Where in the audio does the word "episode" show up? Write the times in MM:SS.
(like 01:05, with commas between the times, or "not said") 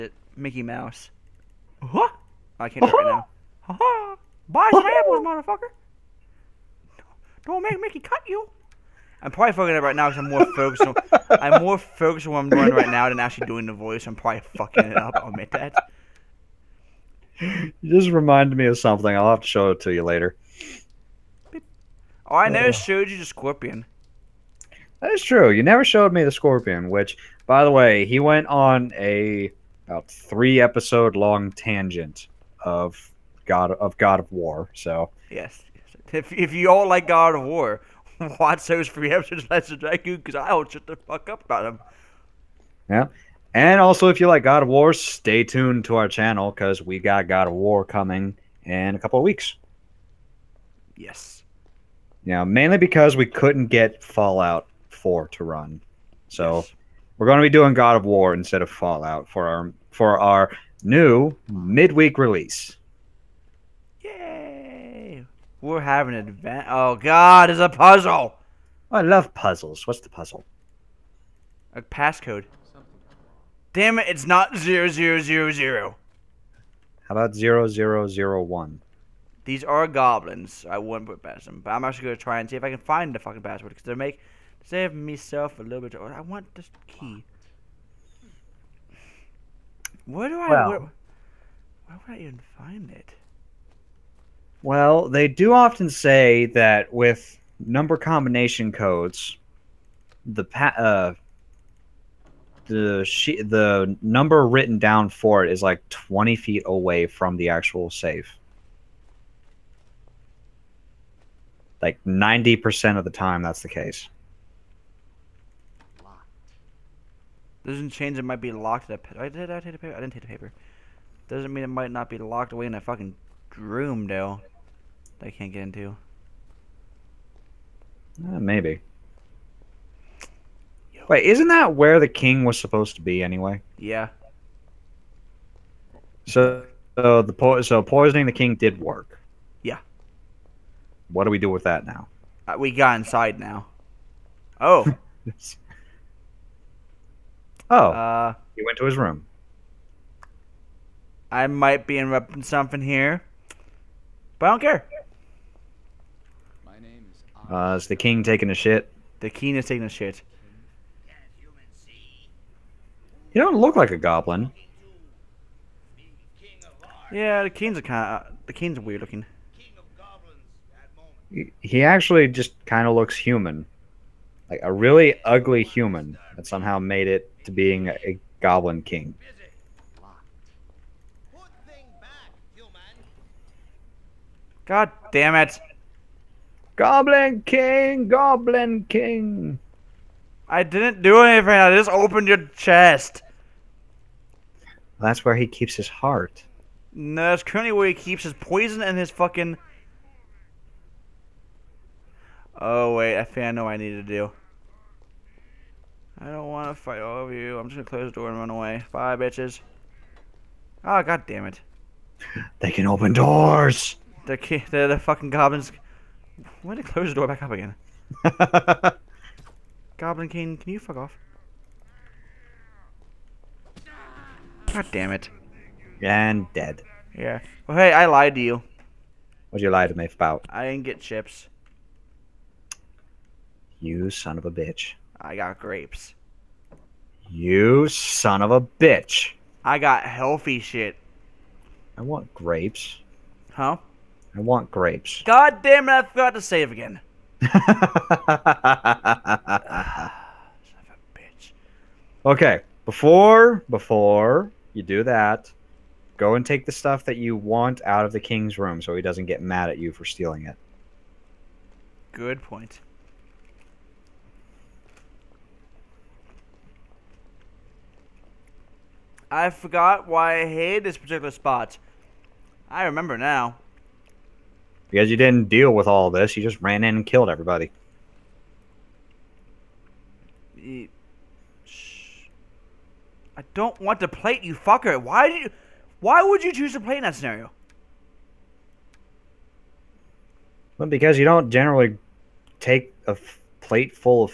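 00:30, 00:39.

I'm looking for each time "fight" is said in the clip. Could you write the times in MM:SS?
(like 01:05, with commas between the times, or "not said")
03:26.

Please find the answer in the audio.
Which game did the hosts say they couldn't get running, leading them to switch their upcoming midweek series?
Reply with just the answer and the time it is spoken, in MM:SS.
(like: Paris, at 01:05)
Fallout 4, at 00:54.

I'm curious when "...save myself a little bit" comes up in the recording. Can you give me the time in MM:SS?
01:24.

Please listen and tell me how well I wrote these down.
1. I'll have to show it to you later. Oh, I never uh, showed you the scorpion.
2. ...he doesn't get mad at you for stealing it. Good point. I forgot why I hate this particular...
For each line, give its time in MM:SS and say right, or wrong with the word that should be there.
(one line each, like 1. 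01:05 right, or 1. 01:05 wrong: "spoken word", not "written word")
1. 00:19 right
2. 04:18 right.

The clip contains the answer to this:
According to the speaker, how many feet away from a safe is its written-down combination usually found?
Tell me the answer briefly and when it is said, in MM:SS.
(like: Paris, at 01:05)
20, at 01:45.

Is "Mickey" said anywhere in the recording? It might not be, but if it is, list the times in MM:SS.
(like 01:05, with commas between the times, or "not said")
00:00, 00:07.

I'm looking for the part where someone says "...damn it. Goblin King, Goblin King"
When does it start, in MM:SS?
03:05.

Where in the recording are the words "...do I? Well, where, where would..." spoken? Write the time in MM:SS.
01:30.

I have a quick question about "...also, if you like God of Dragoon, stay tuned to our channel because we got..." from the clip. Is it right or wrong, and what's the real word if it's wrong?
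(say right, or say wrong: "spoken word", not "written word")
wrong: "War", not "Dragoon".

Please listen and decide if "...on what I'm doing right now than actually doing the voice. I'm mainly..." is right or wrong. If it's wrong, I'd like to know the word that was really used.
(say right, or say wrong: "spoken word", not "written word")
wrong: "probably", not "mainly".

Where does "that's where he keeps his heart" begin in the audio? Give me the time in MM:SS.
03:14.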